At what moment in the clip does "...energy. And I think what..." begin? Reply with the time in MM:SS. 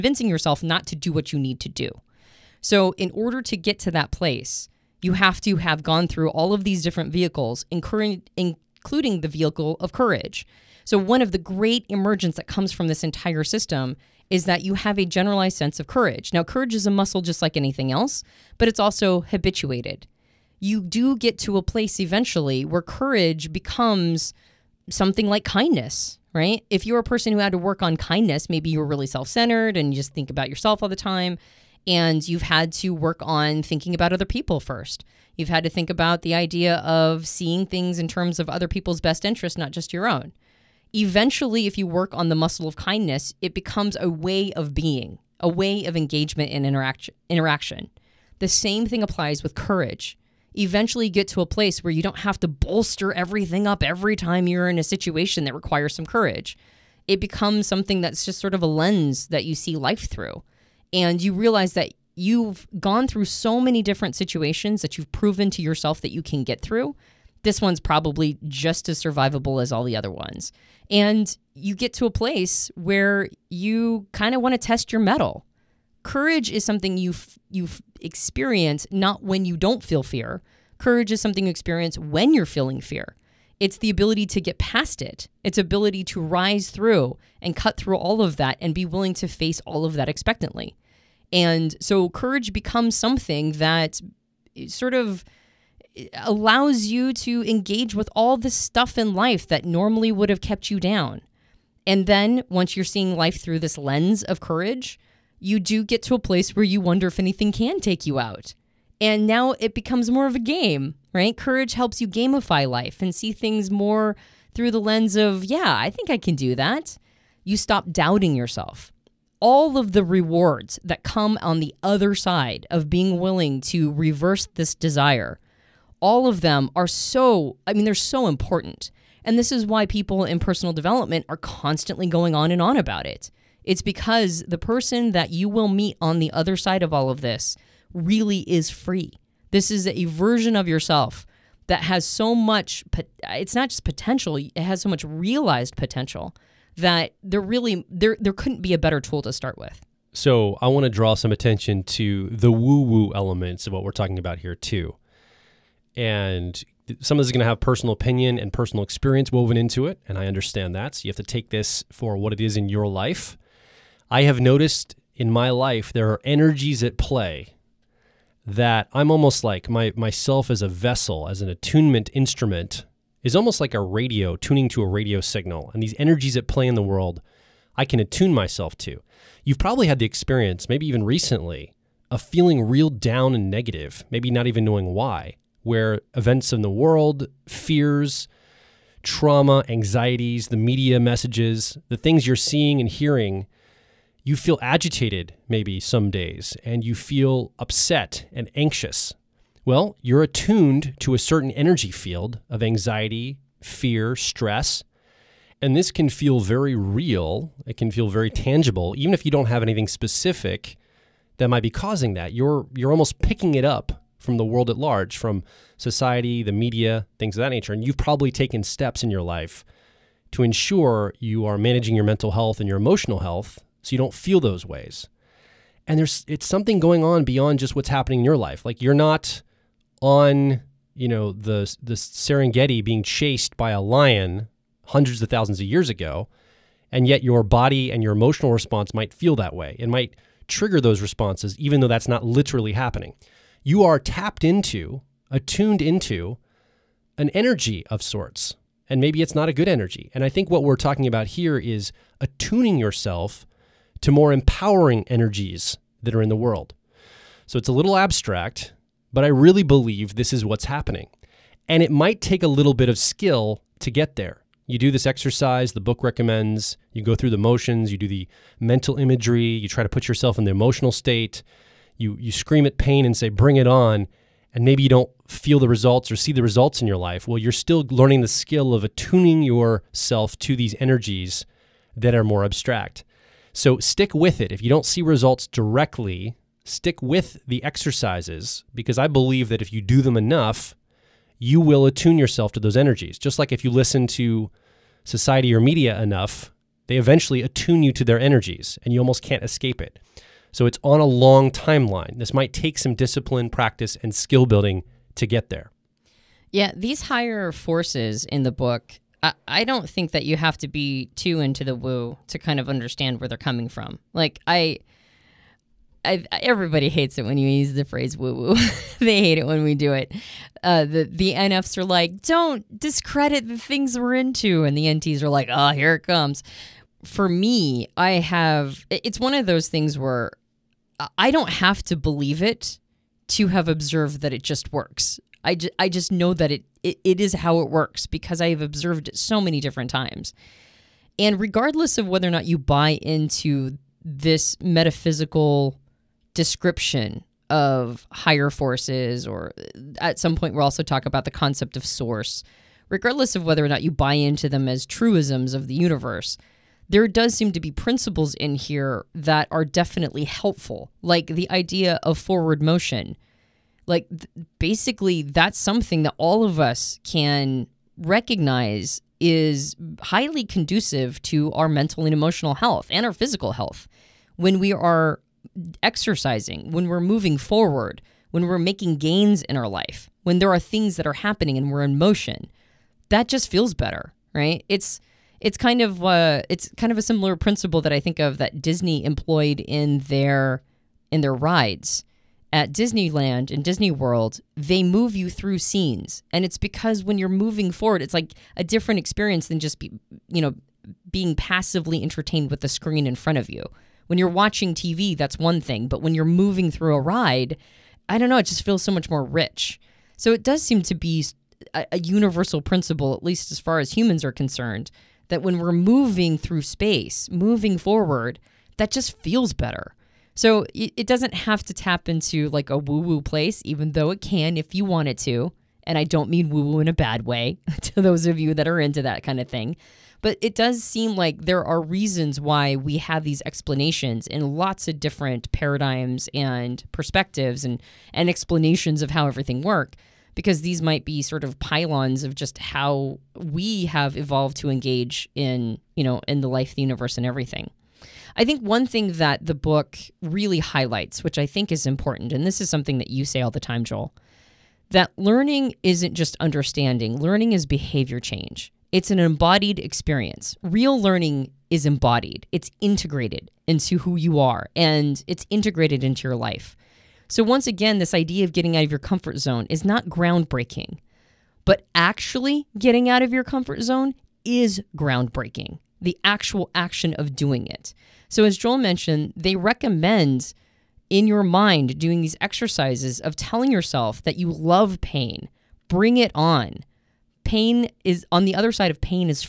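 04:09.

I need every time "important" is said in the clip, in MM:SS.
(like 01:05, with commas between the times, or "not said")
02:08, 07:31.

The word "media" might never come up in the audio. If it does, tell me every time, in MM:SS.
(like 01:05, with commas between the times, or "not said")
03:10, 03:36, 04:55.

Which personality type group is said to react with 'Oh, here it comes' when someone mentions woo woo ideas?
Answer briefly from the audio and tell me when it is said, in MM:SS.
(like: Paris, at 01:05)
the NTs, at 05:24.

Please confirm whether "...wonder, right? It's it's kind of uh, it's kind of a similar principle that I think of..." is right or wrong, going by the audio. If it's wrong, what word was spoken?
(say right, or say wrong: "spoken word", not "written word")
wrong: "better", not "wonder".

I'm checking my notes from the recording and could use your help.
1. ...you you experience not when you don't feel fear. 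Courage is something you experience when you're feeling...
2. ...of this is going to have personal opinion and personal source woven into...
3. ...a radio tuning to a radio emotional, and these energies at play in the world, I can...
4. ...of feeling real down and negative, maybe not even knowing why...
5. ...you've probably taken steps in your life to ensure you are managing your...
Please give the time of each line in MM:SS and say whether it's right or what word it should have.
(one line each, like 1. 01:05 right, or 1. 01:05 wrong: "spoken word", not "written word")
1. 01:16 right
2. 02:37 wrong: "experience", not "source"
3. 02:53 wrong: "signal", not "emotional"
4. 03:02 right
5. 03:37 right.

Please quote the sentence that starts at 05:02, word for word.
This might take some discipline, practice, and skill building to get there.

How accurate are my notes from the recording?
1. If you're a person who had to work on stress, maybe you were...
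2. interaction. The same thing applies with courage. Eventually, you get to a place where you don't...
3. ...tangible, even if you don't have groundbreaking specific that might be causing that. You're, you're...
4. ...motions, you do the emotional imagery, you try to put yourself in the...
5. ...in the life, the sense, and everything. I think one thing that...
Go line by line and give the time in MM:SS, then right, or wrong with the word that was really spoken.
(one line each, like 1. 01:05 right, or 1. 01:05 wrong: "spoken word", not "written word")
1. 00:26 wrong: "kindness", not "stress"
2. 00:47 right
3. 03:28 wrong: "anything", not "groundbreaking"
4. 04:27 wrong: "mental", not "emotional"
5. 07:26 wrong: "universe", not "sense".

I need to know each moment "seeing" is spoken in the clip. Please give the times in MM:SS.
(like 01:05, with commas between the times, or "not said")
00:37, 01:42, 03:12.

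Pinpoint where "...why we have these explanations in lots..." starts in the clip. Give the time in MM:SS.
07:12.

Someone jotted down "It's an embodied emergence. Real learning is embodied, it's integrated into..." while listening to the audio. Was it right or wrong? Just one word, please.
wrong.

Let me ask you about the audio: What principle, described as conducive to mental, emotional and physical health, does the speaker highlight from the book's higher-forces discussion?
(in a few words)
forward motion.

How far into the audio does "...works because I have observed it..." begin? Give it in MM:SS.
05:37.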